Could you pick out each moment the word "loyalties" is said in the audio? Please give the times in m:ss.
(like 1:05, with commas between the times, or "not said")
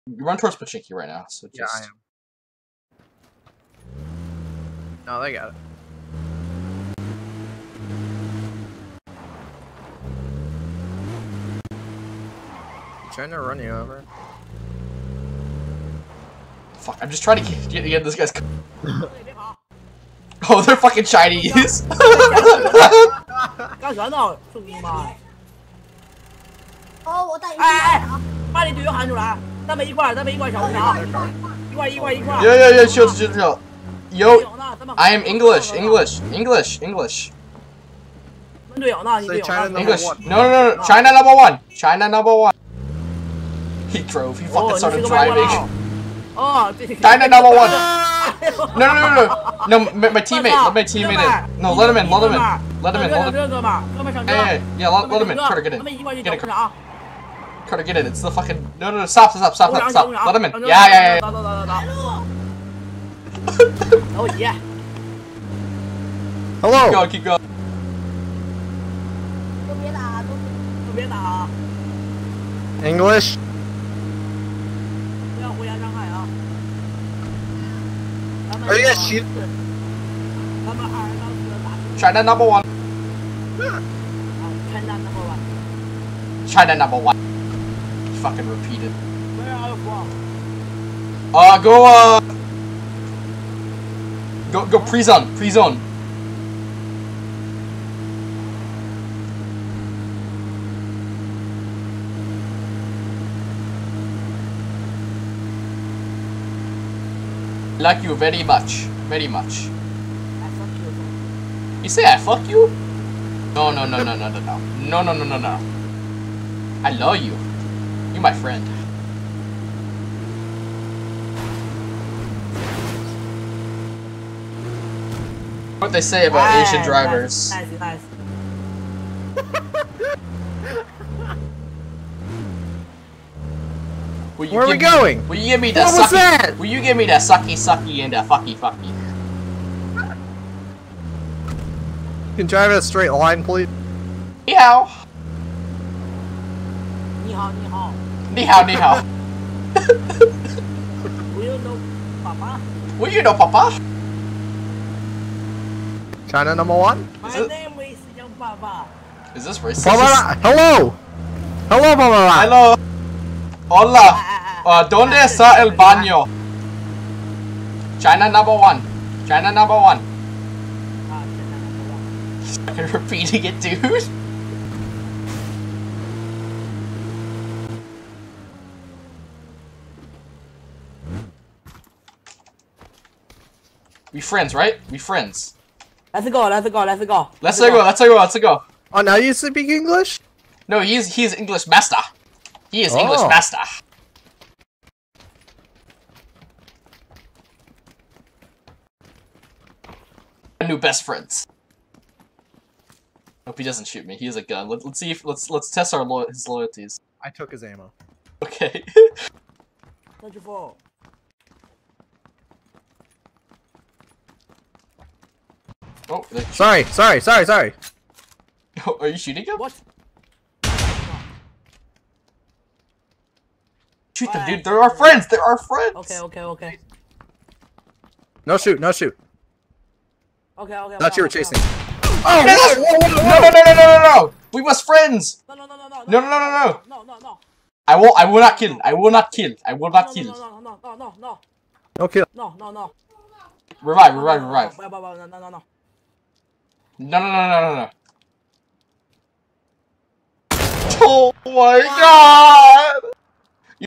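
3:26.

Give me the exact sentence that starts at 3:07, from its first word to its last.
Let's, let's go, go, let's go, let's go.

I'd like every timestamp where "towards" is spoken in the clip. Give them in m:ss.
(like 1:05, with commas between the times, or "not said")
0:00.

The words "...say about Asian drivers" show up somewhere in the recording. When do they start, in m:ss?
2:06.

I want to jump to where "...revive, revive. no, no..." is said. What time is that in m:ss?
4:04.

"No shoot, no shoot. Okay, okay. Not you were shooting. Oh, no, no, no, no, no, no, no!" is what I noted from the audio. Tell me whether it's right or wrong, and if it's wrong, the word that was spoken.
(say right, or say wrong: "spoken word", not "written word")
wrong: "chasing", not "shooting".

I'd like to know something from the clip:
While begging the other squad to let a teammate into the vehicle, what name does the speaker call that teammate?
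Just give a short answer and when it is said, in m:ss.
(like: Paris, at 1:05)
Carter, at 0:57.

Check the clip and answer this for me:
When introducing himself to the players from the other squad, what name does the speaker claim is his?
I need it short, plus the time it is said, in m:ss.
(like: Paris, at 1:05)
Young Papa, at 2:38.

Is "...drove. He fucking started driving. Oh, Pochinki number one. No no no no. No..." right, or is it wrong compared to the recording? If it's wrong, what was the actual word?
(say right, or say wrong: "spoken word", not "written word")
wrong: "China", not "Pochinki".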